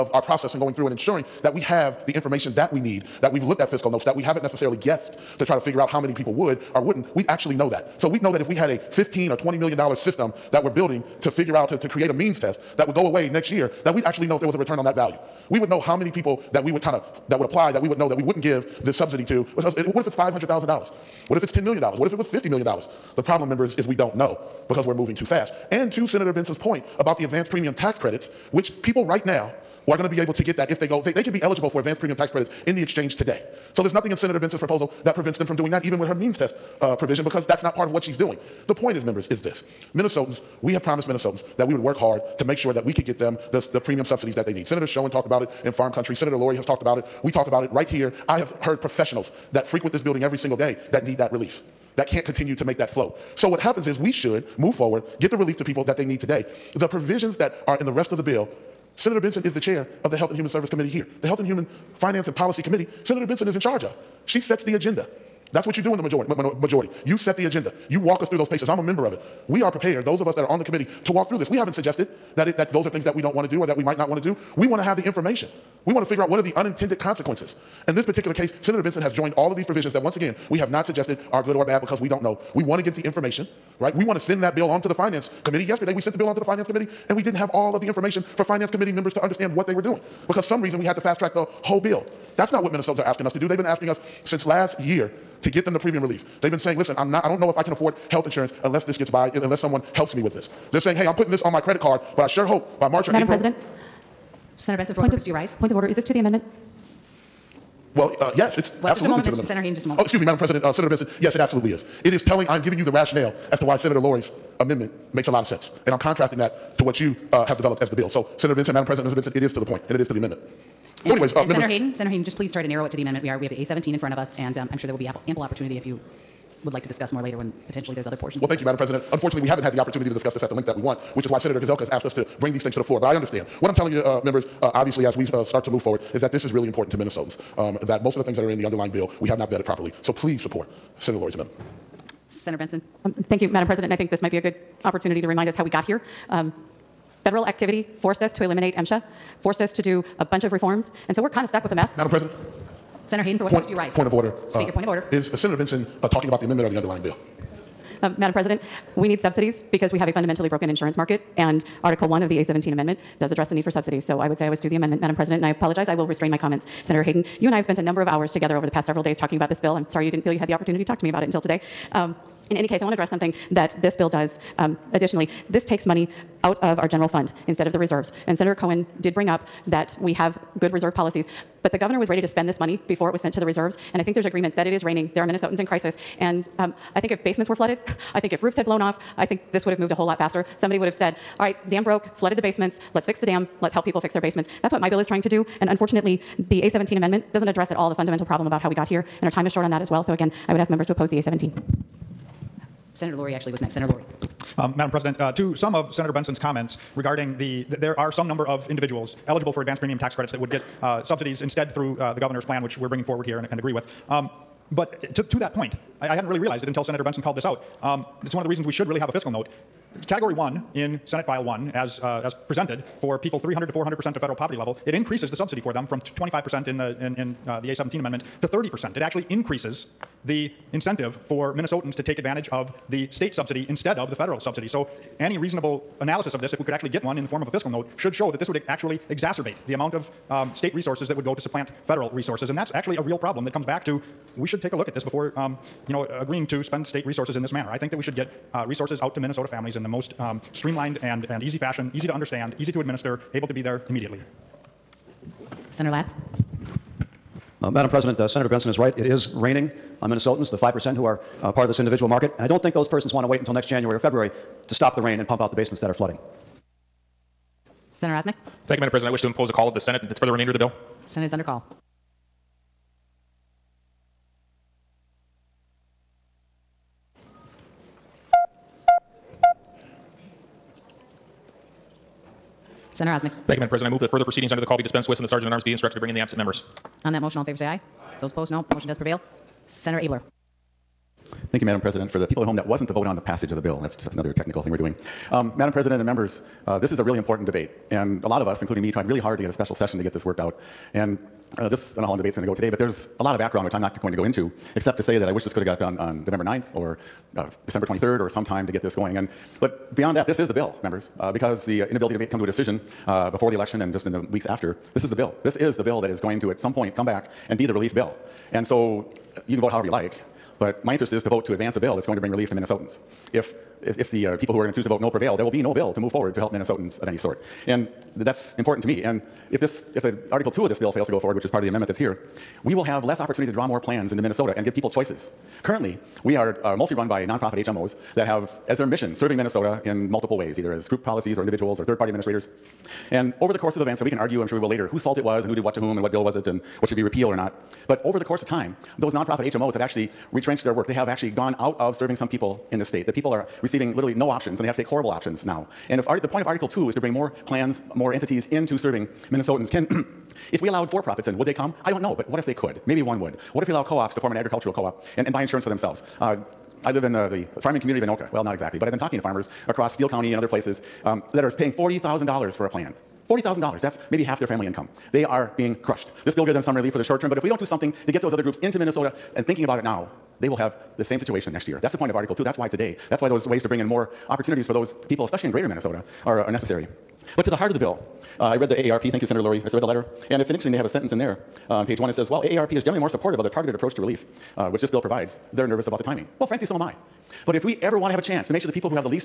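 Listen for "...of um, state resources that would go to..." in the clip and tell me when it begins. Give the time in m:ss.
3:59.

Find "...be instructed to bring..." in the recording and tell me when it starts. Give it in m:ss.
4:45.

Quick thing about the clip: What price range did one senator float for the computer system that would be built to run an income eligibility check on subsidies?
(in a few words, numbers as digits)
15 or 20 million dollars.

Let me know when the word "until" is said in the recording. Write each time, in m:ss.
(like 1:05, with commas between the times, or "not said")
2:51, 3:36, 4:23.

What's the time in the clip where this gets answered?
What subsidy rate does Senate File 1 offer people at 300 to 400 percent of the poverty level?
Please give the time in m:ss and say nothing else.
3:48.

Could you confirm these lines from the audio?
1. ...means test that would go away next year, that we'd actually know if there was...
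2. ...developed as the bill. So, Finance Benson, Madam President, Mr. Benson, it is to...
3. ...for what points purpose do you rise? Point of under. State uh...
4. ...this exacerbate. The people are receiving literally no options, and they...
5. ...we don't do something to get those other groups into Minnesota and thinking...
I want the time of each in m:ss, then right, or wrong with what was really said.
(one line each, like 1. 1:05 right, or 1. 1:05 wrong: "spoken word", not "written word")
1. 0:12 right
2. 1:57 wrong: "Senator", not "Finance"
3. 2:33 wrong: "order", not "under"
4. 5:52 wrong: "state", not "exacerbate"
5. 6:17 right.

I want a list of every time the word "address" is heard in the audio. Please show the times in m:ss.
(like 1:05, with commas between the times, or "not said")
2:43, 2:52, 3:17.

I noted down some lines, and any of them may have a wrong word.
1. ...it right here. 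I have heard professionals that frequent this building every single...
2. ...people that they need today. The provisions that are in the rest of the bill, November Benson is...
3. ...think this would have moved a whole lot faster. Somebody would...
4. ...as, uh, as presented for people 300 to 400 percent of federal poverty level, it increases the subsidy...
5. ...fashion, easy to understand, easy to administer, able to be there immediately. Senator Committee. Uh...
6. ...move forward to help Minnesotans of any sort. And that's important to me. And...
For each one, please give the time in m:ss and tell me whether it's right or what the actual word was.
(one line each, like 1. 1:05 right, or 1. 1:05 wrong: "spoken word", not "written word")
1. 0:47 right
2. 0:55 wrong: "Senator", not "November"
3. 3:09 right
4. 3:41 right
5. 4:11 wrong: "Latz", not "Committee"
6. 5:25 right.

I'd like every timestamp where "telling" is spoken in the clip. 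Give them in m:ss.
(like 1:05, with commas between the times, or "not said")
1:52, 2:13.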